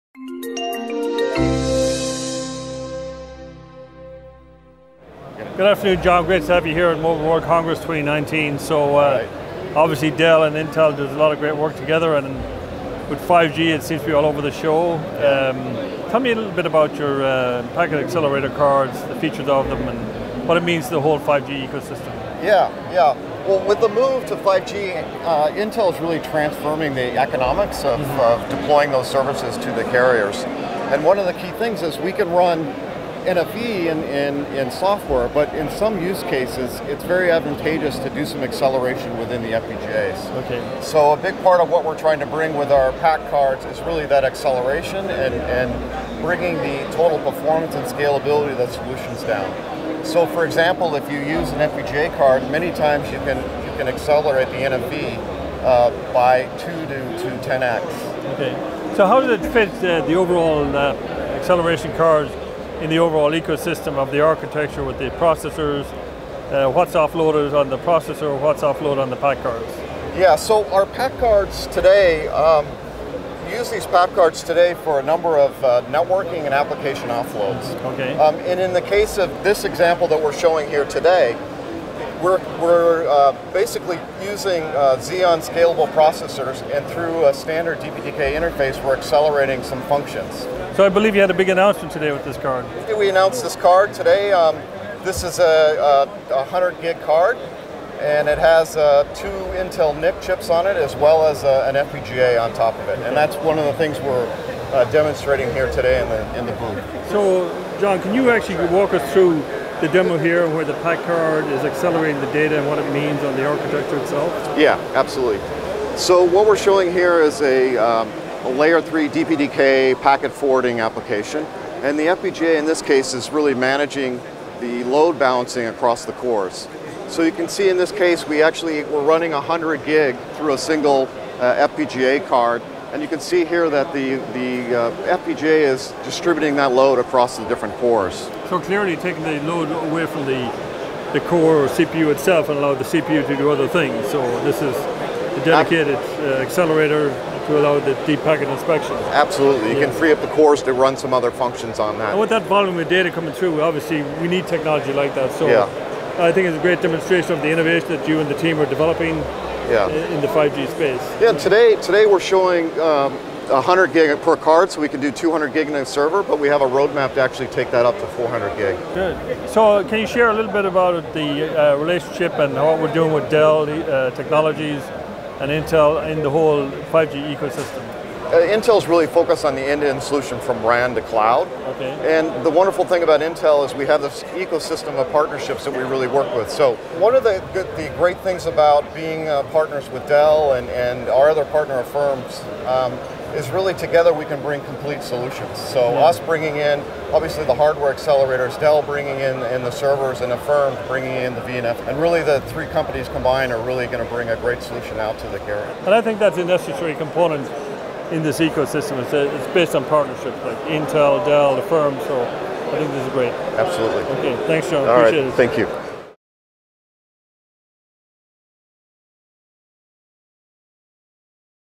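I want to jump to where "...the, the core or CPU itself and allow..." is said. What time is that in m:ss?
2:20.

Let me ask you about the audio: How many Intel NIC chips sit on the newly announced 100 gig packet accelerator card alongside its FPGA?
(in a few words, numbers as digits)
2.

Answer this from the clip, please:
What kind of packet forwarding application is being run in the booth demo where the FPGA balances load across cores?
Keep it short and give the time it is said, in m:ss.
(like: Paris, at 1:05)
Layer 3 DPDK, at 1:58.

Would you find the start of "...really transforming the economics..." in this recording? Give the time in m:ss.
0:26.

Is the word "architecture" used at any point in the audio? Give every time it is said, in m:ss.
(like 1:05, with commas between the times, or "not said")
1:04, 1:53.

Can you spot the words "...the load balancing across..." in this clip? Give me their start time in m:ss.
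2:04.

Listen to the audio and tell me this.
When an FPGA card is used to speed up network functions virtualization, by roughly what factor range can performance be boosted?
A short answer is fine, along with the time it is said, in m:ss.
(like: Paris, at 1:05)
2 to 10x, at 0:56.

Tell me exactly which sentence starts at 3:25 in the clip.
And I think that's a necessary component in this ecosystem.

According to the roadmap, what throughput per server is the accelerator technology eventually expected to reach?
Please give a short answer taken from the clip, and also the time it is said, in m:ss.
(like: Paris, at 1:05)
400 gig, at 2:48.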